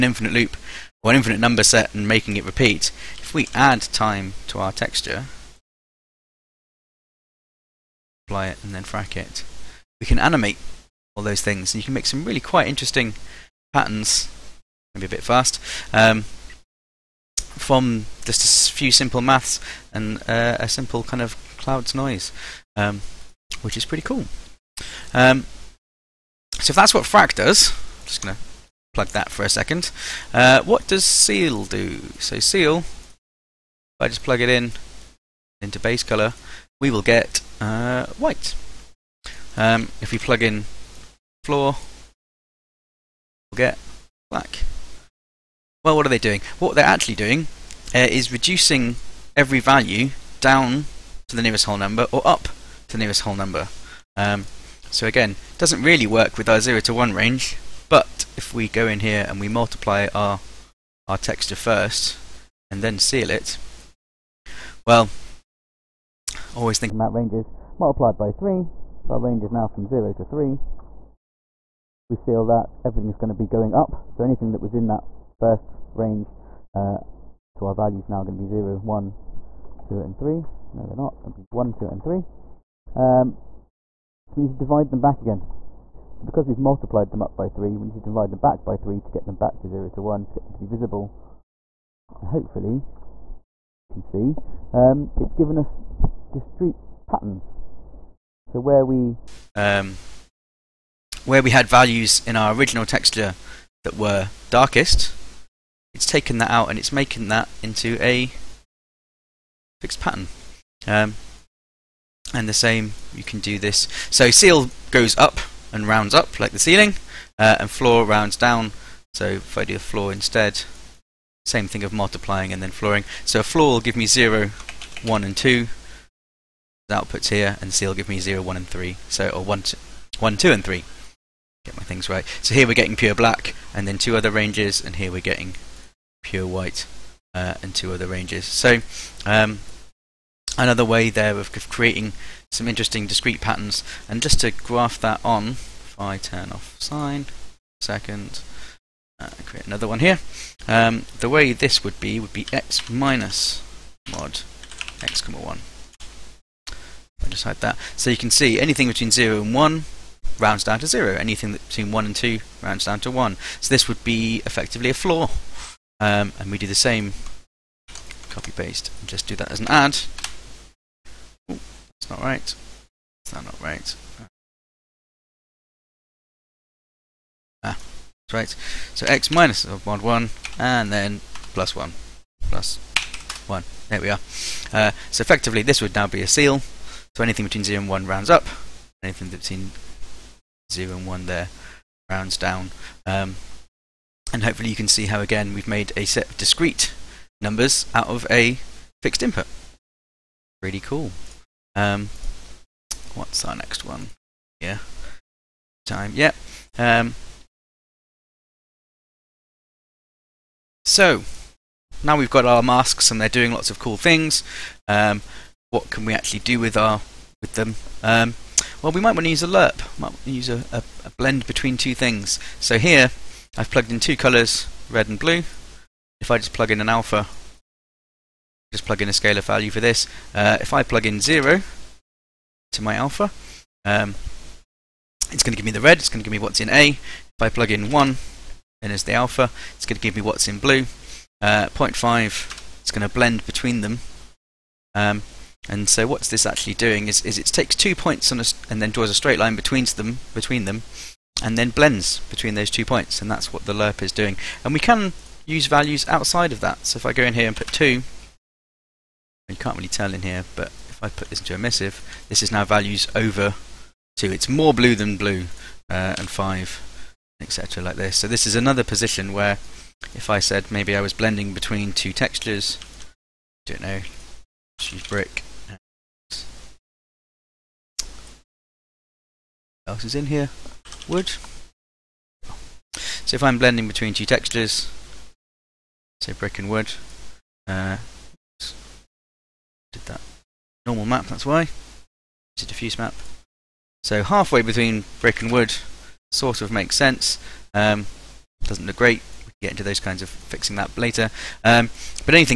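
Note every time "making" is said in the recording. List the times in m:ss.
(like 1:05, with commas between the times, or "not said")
0:02, 1:46.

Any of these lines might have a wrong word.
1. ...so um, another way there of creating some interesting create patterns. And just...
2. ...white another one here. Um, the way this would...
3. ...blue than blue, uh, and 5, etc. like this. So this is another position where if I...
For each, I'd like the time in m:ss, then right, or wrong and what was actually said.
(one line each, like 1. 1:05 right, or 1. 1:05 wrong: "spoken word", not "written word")
1. 2:18 wrong: "discrete", not "create"
2. 2:29 wrong: "create", not "white"
3. 4:24 right.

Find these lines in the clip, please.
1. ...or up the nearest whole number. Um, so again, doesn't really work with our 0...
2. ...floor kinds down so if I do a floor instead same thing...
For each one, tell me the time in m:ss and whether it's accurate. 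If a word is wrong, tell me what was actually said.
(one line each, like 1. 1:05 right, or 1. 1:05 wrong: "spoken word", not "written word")
1. 0:52 right
2. 1:57 wrong: "rounds", not "kinds".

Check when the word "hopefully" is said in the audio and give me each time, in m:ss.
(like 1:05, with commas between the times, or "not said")
1:32, 3:14.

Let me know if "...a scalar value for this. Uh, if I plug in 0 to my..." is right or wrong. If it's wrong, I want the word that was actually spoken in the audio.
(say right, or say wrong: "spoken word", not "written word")
right.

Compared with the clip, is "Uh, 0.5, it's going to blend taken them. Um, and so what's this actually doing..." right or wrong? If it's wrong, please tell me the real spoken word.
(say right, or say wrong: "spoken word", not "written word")
wrong: "between", not "taken".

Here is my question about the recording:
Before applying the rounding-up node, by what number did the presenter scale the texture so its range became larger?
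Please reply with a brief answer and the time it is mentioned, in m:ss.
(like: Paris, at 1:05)
3, at 1:07.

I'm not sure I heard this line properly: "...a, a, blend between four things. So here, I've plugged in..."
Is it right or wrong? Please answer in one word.
wrong.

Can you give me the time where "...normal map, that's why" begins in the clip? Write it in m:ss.
4:50.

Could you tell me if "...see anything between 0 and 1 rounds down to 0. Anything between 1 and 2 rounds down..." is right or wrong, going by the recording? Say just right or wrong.
right.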